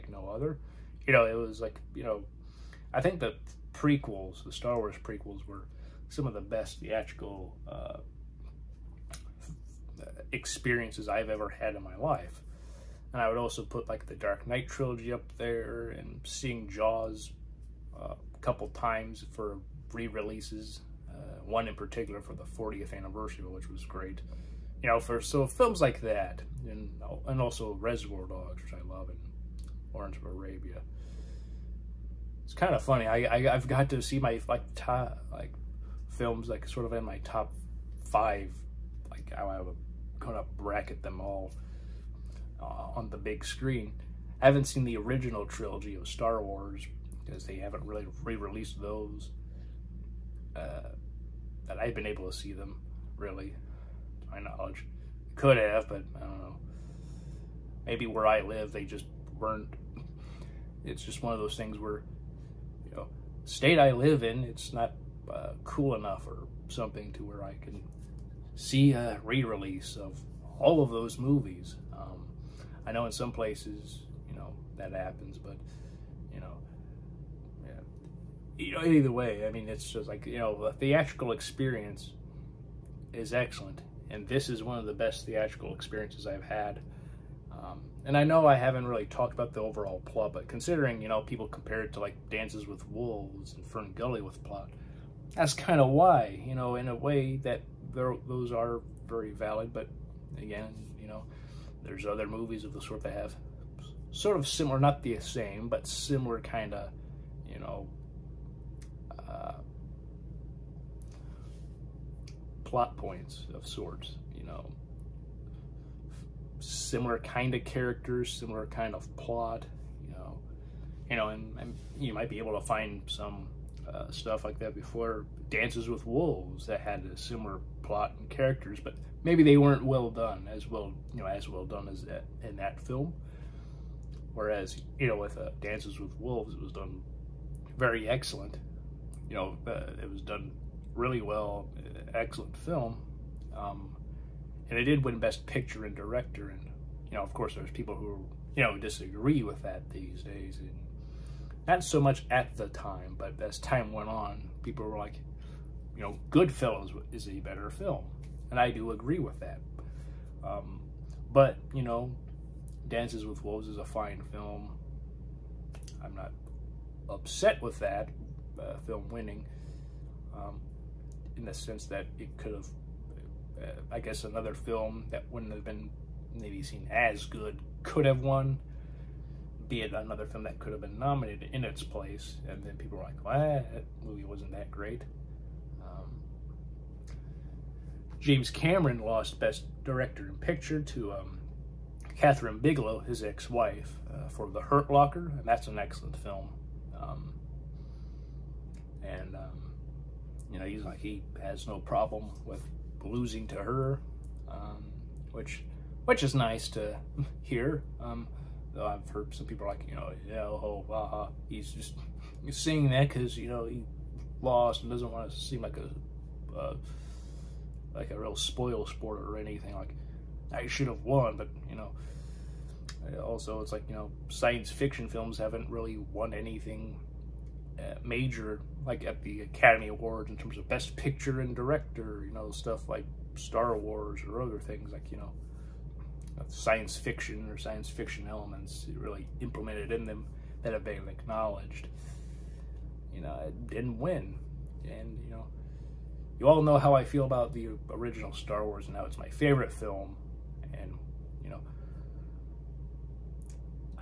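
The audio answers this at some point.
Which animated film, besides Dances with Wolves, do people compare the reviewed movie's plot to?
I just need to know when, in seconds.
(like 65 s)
93 s.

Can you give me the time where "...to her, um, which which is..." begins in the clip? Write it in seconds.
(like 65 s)
203 s.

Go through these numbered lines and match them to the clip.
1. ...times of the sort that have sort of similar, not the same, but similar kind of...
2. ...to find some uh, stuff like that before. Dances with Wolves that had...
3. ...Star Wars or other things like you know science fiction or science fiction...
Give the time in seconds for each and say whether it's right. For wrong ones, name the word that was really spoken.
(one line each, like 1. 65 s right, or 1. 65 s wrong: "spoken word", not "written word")
1. 102 s wrong: "movies", not "times"
2. 122 s right
3. 233 s right.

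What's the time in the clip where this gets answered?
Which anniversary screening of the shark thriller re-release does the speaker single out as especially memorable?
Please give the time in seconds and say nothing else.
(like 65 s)
22 s.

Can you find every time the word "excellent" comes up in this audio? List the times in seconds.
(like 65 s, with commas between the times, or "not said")
83 s, 138 s, 142 s, 195 s.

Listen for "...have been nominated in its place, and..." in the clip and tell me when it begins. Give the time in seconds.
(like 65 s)
180 s.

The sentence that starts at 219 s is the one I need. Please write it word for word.
Like I should have won, but you know.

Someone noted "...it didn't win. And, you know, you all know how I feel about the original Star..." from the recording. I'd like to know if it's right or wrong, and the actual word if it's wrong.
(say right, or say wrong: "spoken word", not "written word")
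right.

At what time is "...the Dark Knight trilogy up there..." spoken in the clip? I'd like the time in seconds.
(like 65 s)
14 s.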